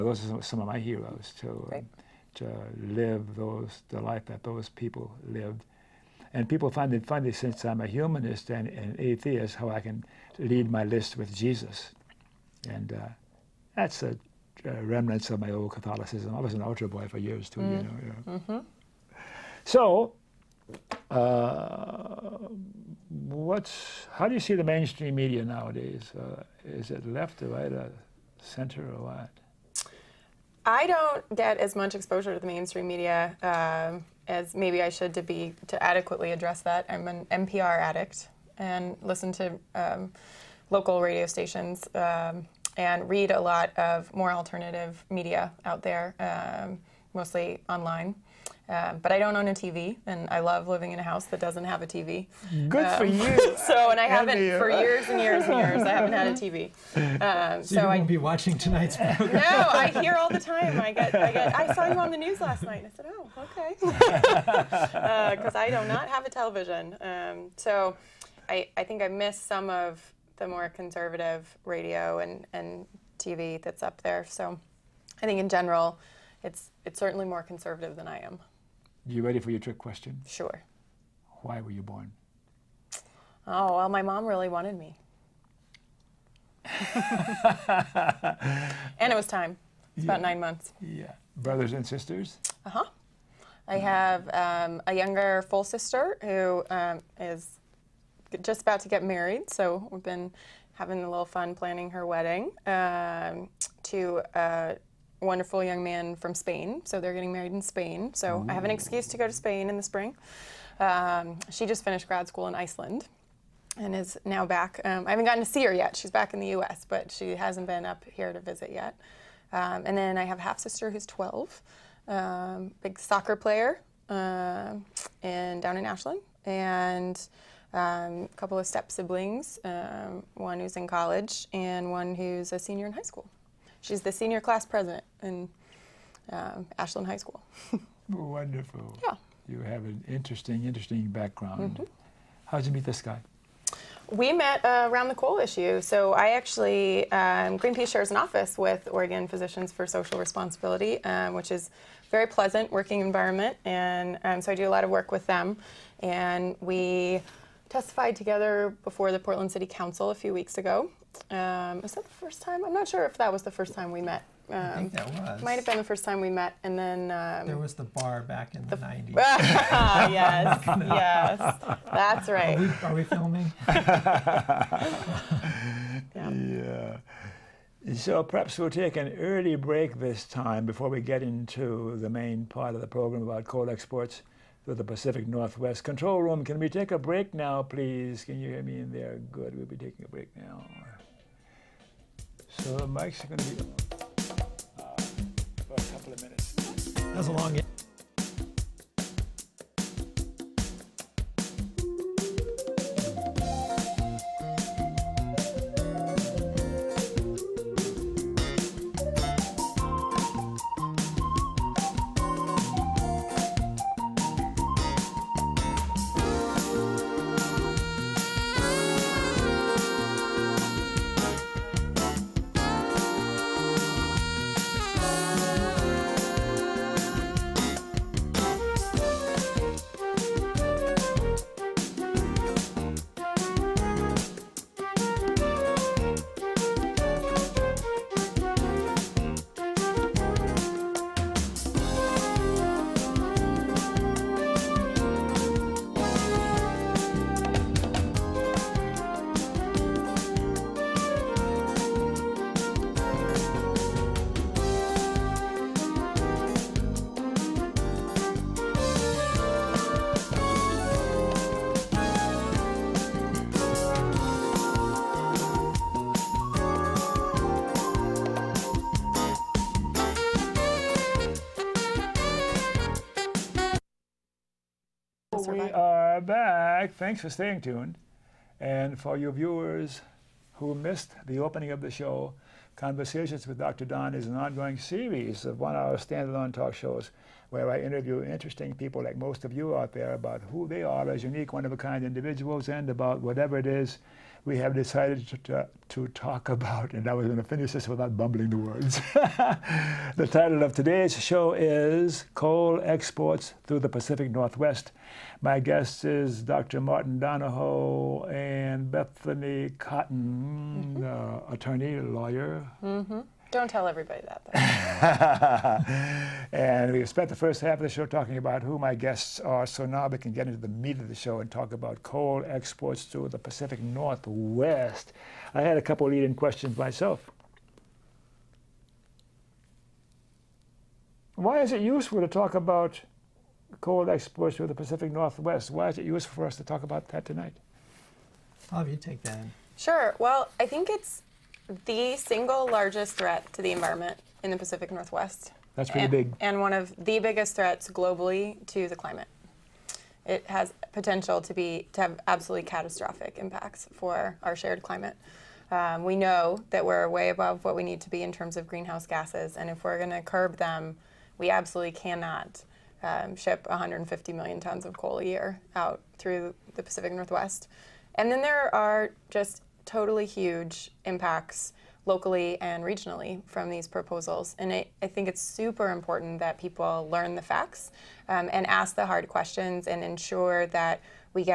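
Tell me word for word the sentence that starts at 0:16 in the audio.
I was an altar boy for years too, mm.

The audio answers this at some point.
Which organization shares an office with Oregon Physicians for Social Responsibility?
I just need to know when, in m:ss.
2:27.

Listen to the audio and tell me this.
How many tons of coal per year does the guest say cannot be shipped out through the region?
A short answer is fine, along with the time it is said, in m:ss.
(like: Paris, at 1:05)
150 million tons, at 6:03.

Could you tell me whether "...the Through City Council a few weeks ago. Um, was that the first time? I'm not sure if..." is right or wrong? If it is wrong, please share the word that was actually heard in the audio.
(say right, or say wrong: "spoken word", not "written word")
wrong: "Portland", not "Through".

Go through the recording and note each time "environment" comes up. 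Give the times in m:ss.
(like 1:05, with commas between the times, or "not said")
2:33, 5:43.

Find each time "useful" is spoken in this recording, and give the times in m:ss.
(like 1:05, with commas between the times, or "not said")
5:31, 5:36.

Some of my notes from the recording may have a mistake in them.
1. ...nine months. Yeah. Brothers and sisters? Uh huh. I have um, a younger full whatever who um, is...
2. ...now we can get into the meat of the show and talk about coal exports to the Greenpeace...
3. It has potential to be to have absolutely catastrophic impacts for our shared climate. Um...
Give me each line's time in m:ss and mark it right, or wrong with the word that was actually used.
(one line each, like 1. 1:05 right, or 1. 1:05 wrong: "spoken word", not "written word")
1. 1:30 wrong: "sister", not "whatever"
2. 5:19 wrong: "Pacific", not "Greenpeace"
3. 5:50 right.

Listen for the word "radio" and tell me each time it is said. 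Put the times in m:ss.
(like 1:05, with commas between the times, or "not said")
0:41, 1:11.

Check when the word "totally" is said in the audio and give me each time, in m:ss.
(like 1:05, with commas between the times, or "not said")
6:09.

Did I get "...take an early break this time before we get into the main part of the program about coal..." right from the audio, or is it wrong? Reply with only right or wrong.
right.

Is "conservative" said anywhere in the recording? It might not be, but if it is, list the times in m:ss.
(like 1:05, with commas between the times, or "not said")
1:10, 1:17.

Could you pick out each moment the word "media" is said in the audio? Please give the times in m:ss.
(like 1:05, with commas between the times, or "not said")
0:25, 0:32, 0:45.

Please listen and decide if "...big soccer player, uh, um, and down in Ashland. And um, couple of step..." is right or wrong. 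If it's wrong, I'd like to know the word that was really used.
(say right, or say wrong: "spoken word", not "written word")
right.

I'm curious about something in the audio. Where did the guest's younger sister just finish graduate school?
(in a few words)
Iceland.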